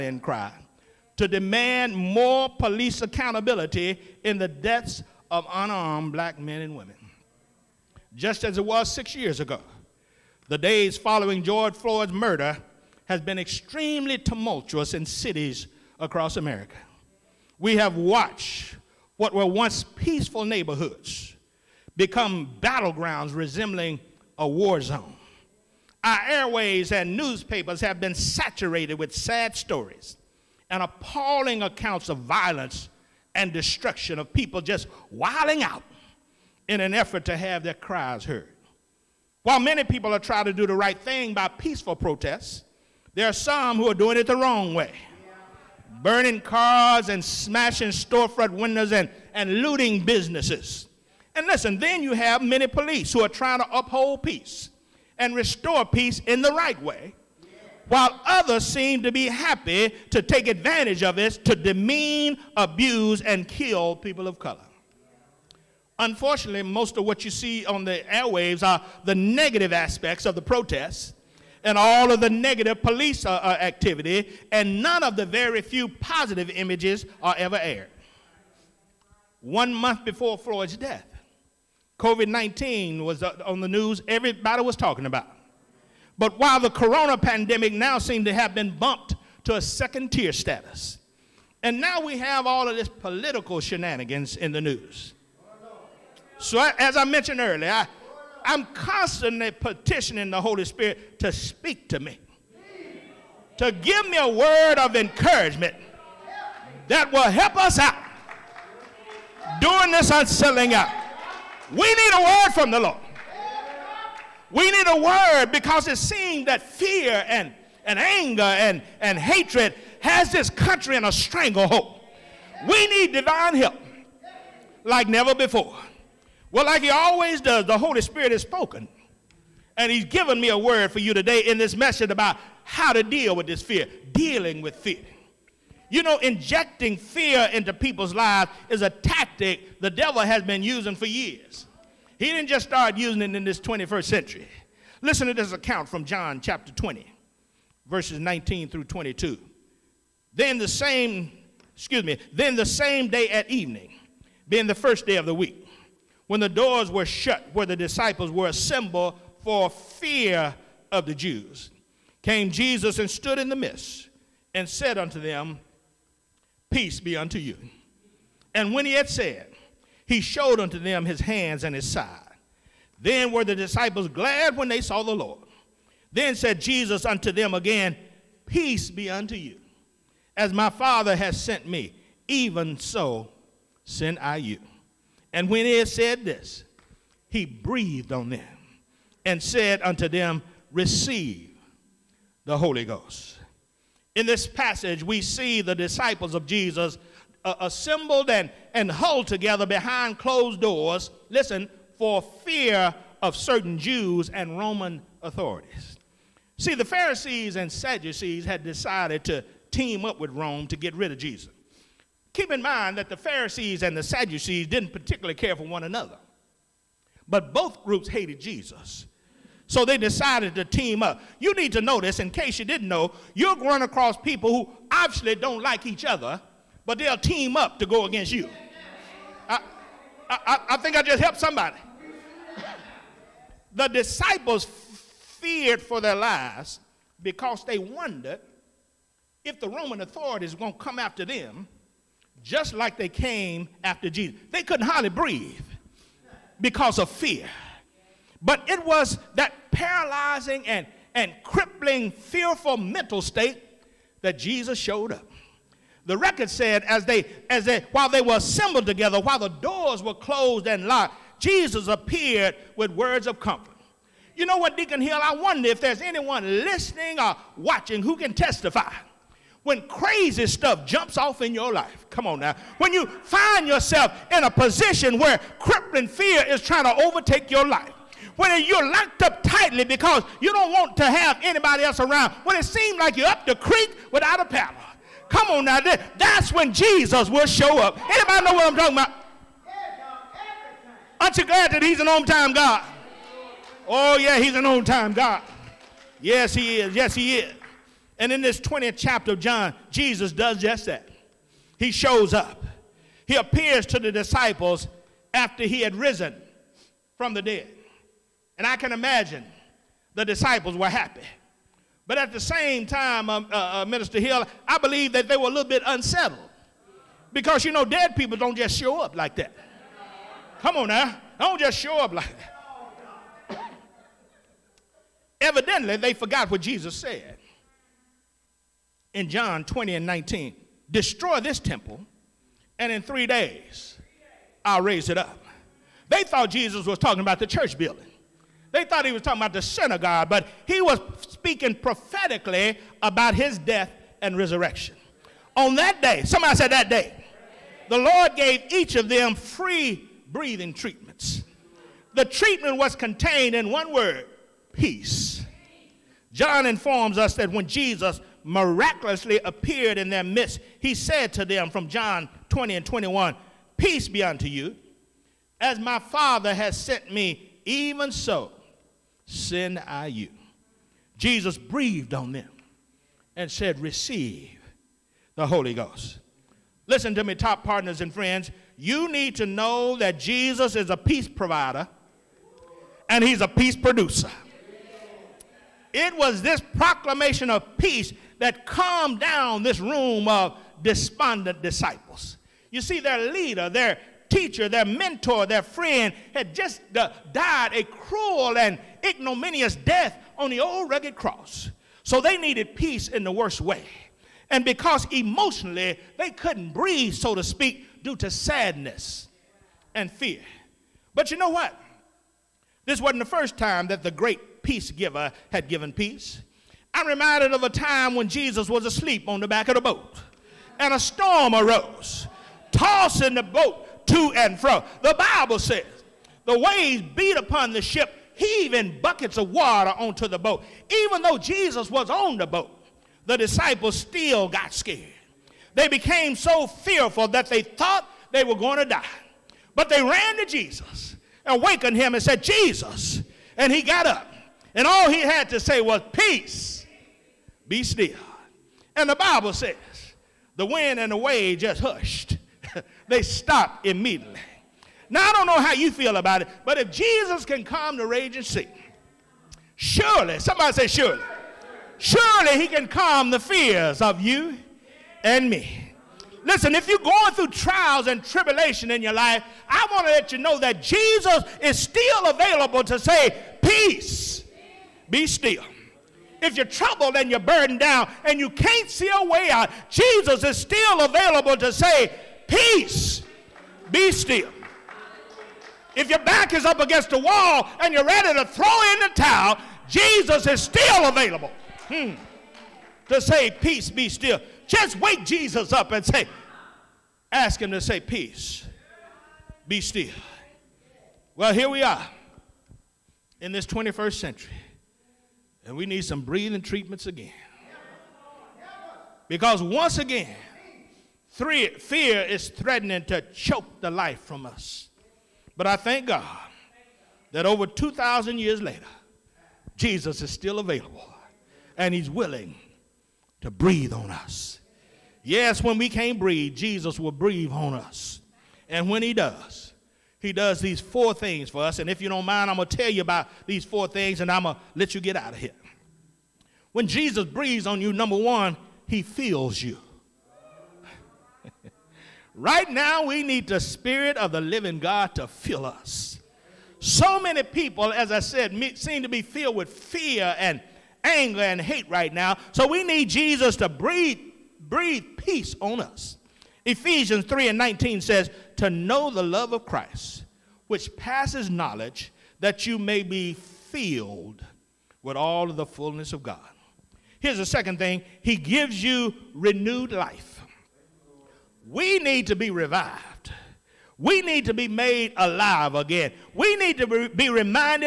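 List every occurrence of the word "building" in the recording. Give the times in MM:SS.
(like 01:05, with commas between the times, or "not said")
05:37.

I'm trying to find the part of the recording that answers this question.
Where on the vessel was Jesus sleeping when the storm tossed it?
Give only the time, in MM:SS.
06:59.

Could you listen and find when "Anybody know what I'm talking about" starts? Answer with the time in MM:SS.
04:48.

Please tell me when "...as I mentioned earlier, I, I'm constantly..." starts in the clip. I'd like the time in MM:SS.
01:36.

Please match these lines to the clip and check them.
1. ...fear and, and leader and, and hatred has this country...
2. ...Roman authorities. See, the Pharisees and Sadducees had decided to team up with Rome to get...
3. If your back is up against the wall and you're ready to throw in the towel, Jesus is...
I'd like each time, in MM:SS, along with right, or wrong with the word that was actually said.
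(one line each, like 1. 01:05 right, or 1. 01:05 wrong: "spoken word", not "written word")
1. 01:56 wrong: "anger", not "leader"
2. 03:24 right
3. 08:05 right.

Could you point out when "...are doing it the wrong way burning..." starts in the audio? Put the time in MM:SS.
00:43.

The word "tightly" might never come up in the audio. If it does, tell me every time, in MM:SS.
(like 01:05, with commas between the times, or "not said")
04:39.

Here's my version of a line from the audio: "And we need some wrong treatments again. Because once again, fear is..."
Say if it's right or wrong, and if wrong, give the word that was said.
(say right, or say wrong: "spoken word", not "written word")
wrong: "breathing", not "wrong".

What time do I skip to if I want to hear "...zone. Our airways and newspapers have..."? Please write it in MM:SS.
00:24.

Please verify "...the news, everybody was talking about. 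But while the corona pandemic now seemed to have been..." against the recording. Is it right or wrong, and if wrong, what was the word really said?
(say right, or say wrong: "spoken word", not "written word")
right.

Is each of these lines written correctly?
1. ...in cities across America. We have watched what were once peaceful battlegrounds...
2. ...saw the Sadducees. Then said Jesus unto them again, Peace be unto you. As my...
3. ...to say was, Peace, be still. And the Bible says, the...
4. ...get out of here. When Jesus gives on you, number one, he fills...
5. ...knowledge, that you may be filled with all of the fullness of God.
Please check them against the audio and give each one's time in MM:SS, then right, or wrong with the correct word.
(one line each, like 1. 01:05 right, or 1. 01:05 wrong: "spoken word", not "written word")
1. 00:14 wrong: "neighborhoods", not "battlegrounds"
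2. 02:54 wrong: "Lord", not "Sadducees"
3. 07:25 right
4. 08:54 wrong: "breathes", not "gives"
5. 09:21 right.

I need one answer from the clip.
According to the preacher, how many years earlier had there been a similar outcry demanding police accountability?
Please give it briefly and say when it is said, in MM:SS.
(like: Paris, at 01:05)
6, at 00:08.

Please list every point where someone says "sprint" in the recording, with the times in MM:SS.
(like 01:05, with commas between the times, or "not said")
not said.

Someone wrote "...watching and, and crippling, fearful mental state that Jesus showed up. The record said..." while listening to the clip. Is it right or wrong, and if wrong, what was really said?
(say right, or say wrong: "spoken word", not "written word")
wrong: "paralyzing", not "watching".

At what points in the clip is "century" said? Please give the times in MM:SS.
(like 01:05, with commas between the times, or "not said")
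02:24, 08:24.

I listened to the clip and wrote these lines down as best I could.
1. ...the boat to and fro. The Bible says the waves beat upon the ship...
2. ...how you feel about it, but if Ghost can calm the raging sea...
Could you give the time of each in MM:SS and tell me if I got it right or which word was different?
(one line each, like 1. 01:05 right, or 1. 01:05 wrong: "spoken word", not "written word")
1. 07:03 right
2. 07:35 wrong: "Jesus", not "Ghost".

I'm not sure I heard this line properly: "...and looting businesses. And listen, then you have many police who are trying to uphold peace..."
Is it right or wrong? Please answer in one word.
right.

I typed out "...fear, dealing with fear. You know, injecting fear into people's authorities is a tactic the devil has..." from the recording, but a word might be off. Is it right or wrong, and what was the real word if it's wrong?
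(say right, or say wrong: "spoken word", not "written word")
wrong: "lives", not "authorities".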